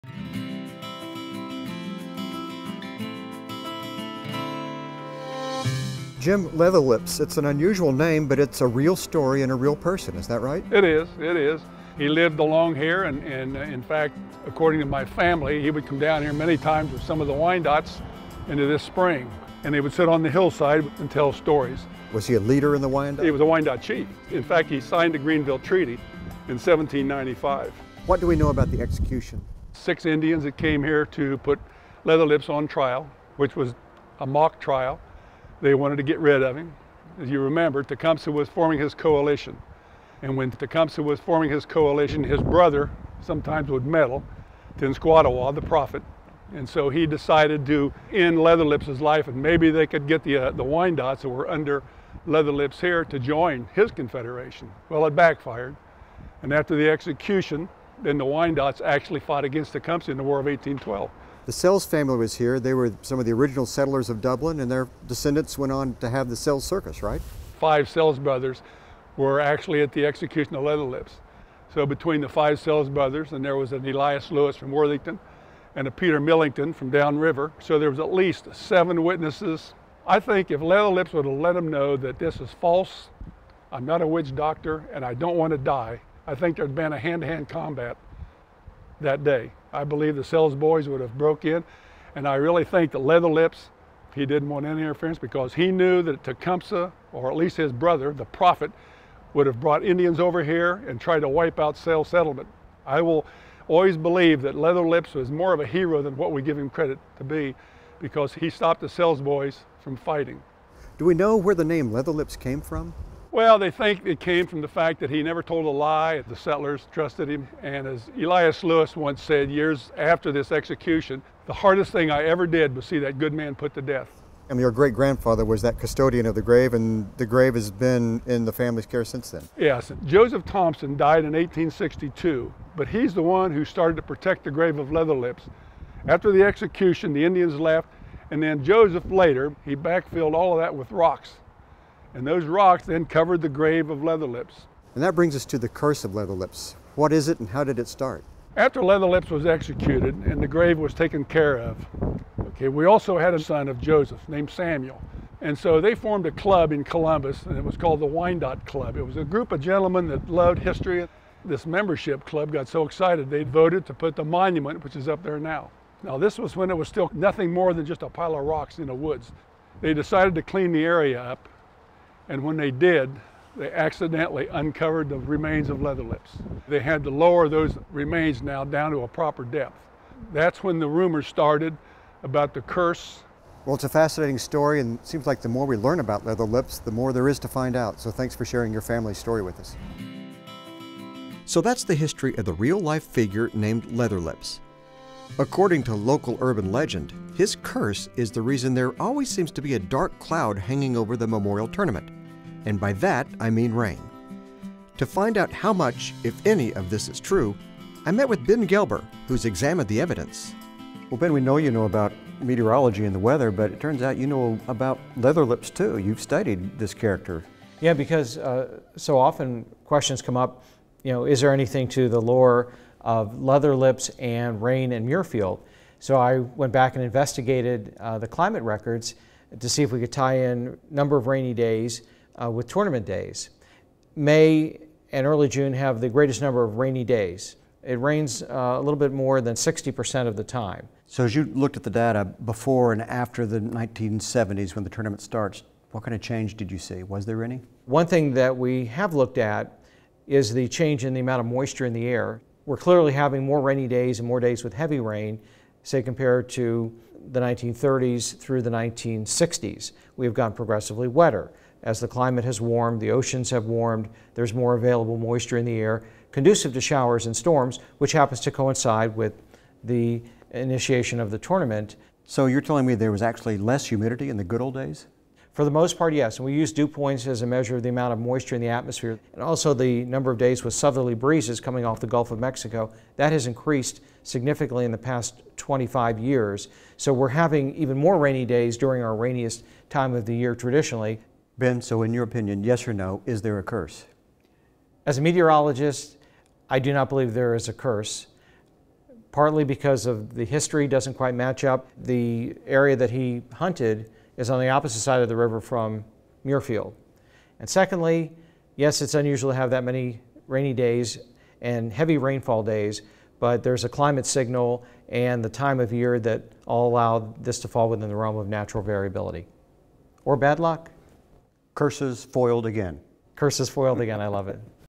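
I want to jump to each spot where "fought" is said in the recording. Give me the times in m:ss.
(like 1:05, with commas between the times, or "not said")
0:59.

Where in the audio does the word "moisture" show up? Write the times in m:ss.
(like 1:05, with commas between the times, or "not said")
4:11, 4:25, 4:38.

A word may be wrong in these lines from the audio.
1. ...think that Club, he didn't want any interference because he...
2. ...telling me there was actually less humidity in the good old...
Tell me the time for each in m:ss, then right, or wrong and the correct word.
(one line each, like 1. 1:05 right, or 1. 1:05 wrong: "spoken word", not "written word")
1. 1:32 wrong: "Leatherlips", not "Club"
2. 4:32 right.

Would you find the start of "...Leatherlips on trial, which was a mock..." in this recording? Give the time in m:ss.
0:32.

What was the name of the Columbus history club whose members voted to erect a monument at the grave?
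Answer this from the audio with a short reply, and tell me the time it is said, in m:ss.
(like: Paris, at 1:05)
Wyandotte Club, at 2:38.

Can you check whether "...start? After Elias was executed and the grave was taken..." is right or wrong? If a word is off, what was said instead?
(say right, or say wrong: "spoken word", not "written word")
wrong: "Leatherlips", not "Elias".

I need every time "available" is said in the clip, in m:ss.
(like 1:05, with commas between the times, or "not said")
4:24.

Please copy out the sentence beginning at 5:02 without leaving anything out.
The area that he hunted is on the opposite side of the river from Muirfield.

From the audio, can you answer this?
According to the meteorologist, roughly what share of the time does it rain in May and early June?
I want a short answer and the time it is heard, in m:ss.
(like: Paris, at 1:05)
a little more than 60%, at 3:58.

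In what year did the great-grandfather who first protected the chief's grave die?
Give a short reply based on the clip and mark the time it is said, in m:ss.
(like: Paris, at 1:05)
1862, at 2:11.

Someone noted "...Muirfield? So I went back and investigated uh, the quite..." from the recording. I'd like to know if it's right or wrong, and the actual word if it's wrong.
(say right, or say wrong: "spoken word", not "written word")
wrong: "climate", not "quite".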